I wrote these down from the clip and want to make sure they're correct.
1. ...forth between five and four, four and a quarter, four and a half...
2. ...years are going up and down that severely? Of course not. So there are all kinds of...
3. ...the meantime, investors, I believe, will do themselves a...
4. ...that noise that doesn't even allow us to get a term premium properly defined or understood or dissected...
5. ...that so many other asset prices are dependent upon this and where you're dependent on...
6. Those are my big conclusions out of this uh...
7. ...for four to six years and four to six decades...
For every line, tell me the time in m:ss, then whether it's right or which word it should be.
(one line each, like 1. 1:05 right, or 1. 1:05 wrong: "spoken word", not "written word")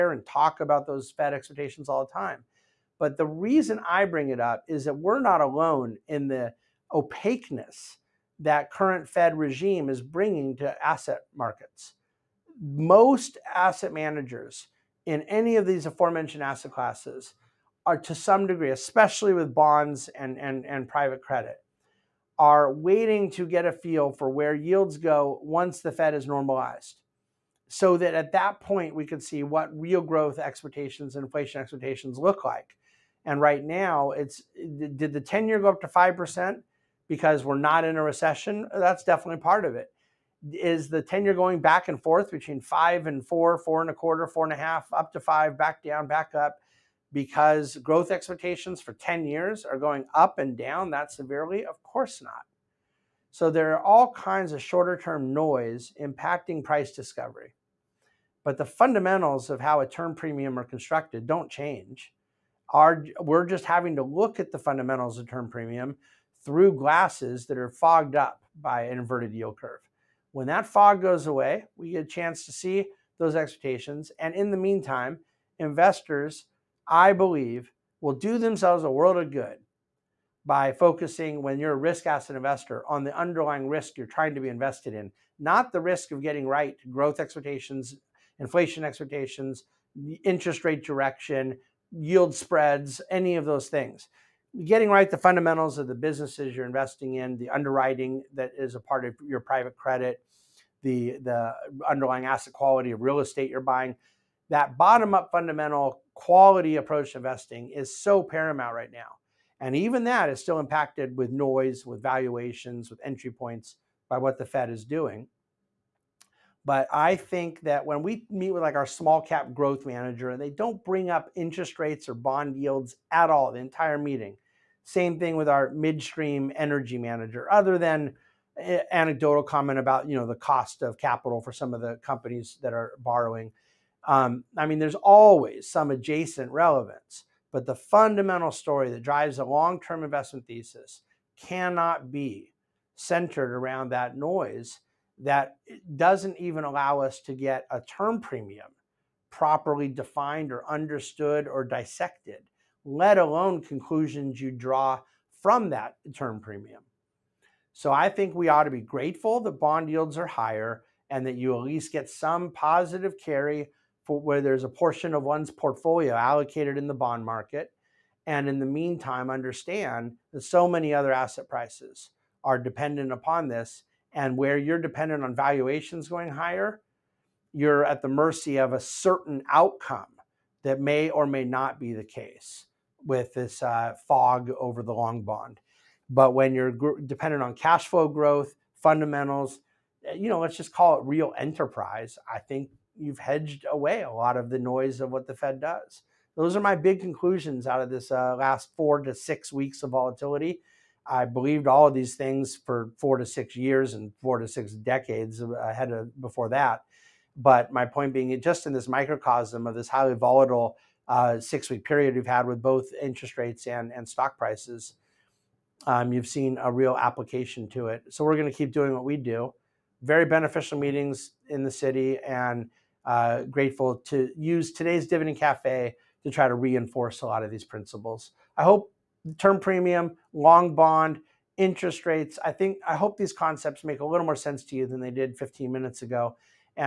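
1. 0:42 right
2. 0:49 right
3. 1:14 right
4. 2:23 right
5. 2:50 right
6. 3:16 right
7. 3:22 right.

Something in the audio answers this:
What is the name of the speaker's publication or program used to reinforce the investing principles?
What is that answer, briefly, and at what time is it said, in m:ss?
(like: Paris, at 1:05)
Dividend Cafe, at 3:45.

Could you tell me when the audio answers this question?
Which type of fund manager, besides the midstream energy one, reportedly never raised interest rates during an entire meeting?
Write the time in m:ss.
1:58.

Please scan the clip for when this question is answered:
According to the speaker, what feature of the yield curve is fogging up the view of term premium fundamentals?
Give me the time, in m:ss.
1:08.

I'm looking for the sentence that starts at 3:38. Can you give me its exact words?
So we're going to keep doing what we do.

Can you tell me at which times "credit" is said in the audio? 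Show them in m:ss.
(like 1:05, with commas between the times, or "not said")
0:21, 1:39.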